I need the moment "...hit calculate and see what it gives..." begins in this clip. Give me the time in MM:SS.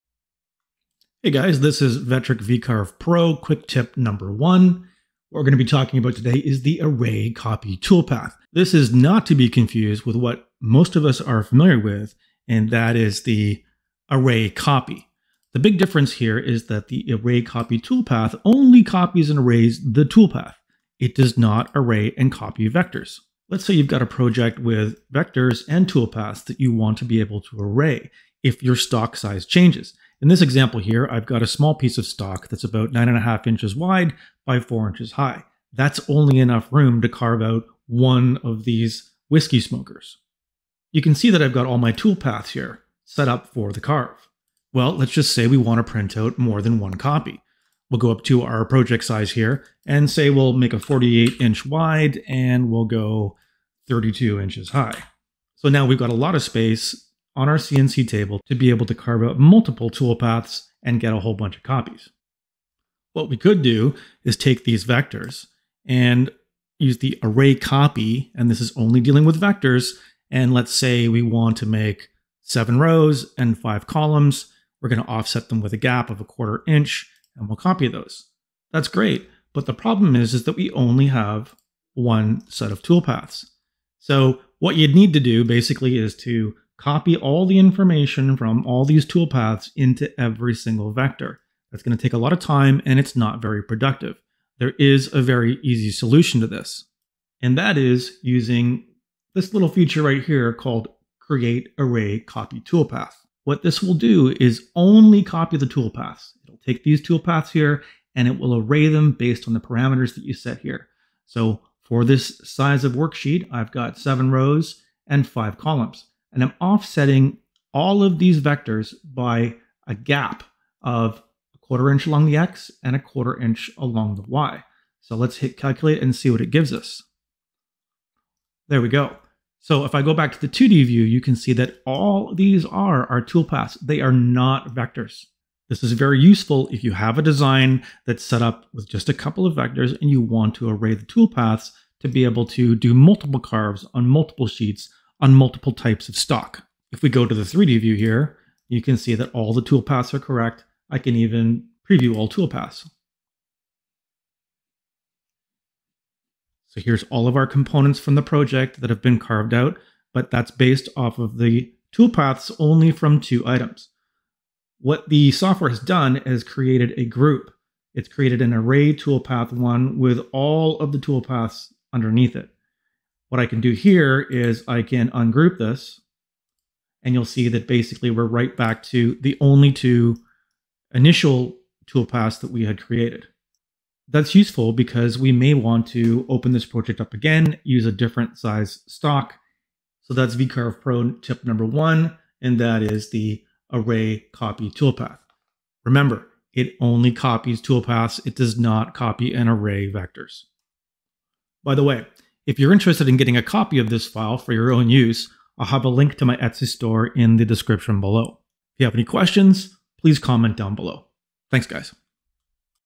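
02:05.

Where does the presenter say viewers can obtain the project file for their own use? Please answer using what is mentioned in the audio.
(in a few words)
Etsy store.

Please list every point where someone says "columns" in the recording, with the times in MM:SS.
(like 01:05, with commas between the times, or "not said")
01:13, 01:55.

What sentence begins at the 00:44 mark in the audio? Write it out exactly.
Well, let's just say we want to print out more than one copy.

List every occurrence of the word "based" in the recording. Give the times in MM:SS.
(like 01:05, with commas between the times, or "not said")
01:49, 02:40.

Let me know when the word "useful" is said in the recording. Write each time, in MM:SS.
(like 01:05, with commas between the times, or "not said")
02:16, 03:04.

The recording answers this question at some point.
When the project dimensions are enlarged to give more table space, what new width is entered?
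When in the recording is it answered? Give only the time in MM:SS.
00:50.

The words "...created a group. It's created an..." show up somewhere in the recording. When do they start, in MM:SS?
02:46.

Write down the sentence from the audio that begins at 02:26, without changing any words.
If we go to the 3D view here, you can see that all the toolpaths are correct.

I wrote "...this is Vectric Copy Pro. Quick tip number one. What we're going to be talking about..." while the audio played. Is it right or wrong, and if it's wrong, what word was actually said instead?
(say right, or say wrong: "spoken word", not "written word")
wrong: "VCarve", not "Copy".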